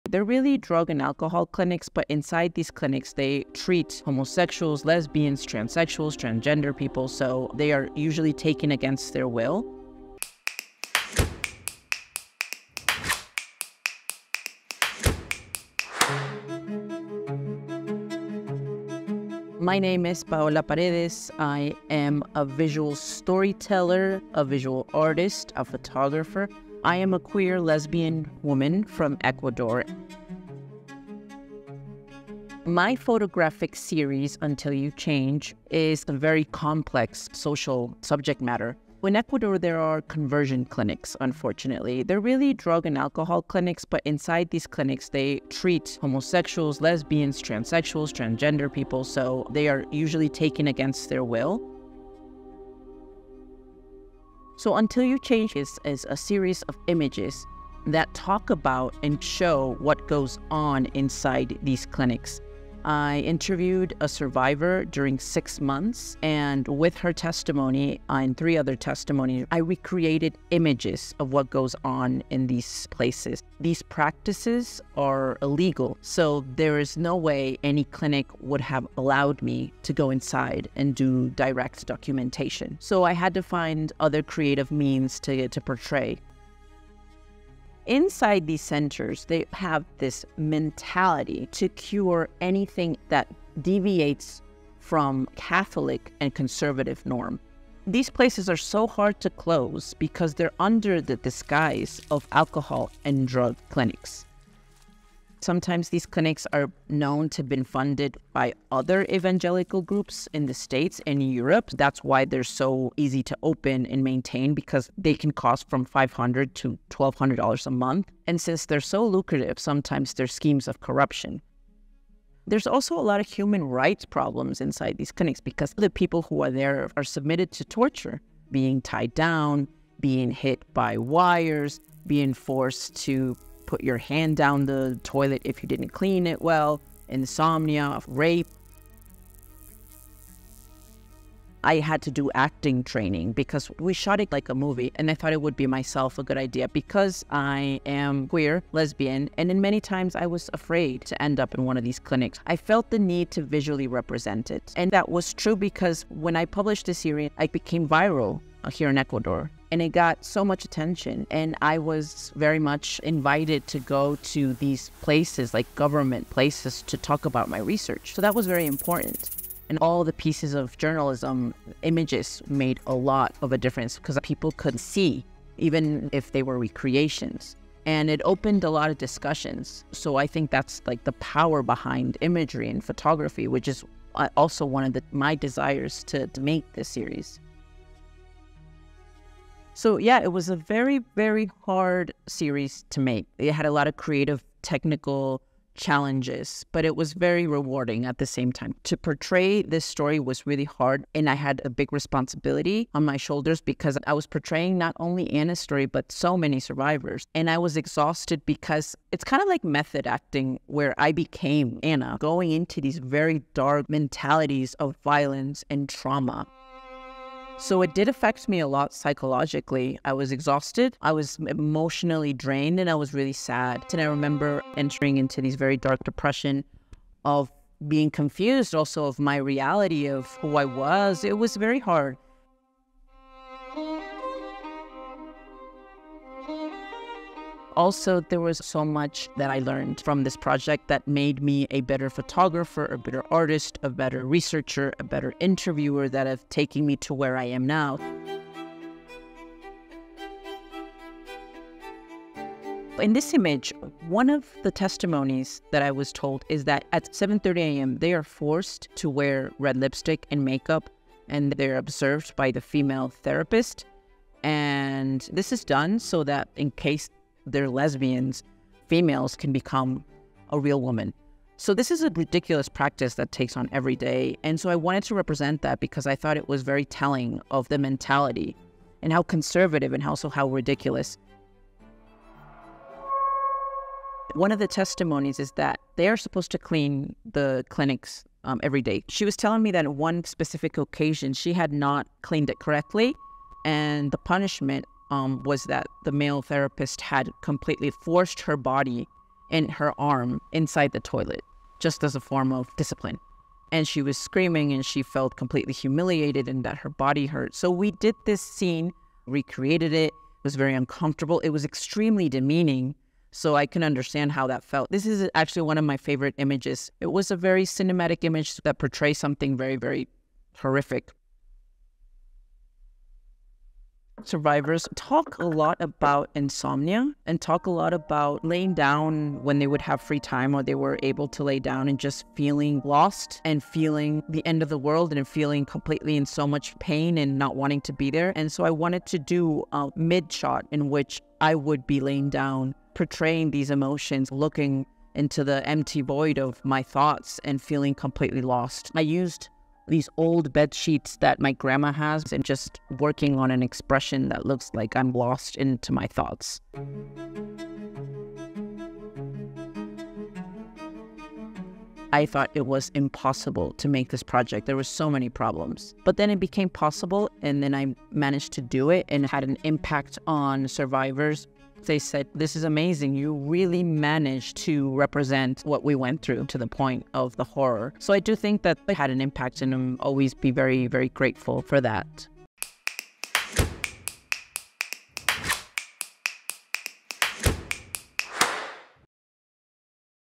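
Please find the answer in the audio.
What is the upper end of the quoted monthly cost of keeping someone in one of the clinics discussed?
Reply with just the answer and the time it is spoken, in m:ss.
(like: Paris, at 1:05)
$1,200, at 1:56.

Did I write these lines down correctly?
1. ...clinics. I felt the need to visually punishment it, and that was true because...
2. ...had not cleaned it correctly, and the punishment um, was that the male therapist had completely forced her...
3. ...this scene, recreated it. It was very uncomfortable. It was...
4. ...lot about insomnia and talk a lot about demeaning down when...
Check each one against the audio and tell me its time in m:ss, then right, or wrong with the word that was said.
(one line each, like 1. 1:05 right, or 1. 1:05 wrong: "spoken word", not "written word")
1. 2:32 wrong: "represent", not "punishment"
2. 4:51 right
3. 5:08 right
4. 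5:25 wrong: "laying", not "demeaning".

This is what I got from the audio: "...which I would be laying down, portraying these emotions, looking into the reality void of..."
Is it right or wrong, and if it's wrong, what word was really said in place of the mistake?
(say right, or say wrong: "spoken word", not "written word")
wrong: "empty", not "reality".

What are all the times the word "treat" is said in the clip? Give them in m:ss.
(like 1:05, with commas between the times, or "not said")
0:03, 0:45.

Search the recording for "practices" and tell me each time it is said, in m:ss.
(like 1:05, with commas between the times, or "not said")
1:13, 4:32.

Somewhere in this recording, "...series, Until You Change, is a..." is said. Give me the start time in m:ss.
0:33.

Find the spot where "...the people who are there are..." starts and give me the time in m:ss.
2:05.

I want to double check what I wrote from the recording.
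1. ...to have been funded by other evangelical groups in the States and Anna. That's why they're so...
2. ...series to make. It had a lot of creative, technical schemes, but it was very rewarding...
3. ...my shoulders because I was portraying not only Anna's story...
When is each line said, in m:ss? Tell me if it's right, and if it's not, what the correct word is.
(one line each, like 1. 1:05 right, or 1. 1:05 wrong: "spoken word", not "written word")
1. 1:47 wrong: "Europe", not "Anna"
2. 3:12 wrong: "challenges", not "schemes"
3. 3:23 right.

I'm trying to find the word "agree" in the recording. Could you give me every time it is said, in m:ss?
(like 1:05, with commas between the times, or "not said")
not said.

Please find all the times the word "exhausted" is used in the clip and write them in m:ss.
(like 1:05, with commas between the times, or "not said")
3:27, 3:40.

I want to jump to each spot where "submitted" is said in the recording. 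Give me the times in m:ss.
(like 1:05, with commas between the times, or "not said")
2:07.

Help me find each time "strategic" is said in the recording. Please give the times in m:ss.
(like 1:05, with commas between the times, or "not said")
not said.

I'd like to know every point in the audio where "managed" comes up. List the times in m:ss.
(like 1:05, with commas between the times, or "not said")
6:08, 6:13.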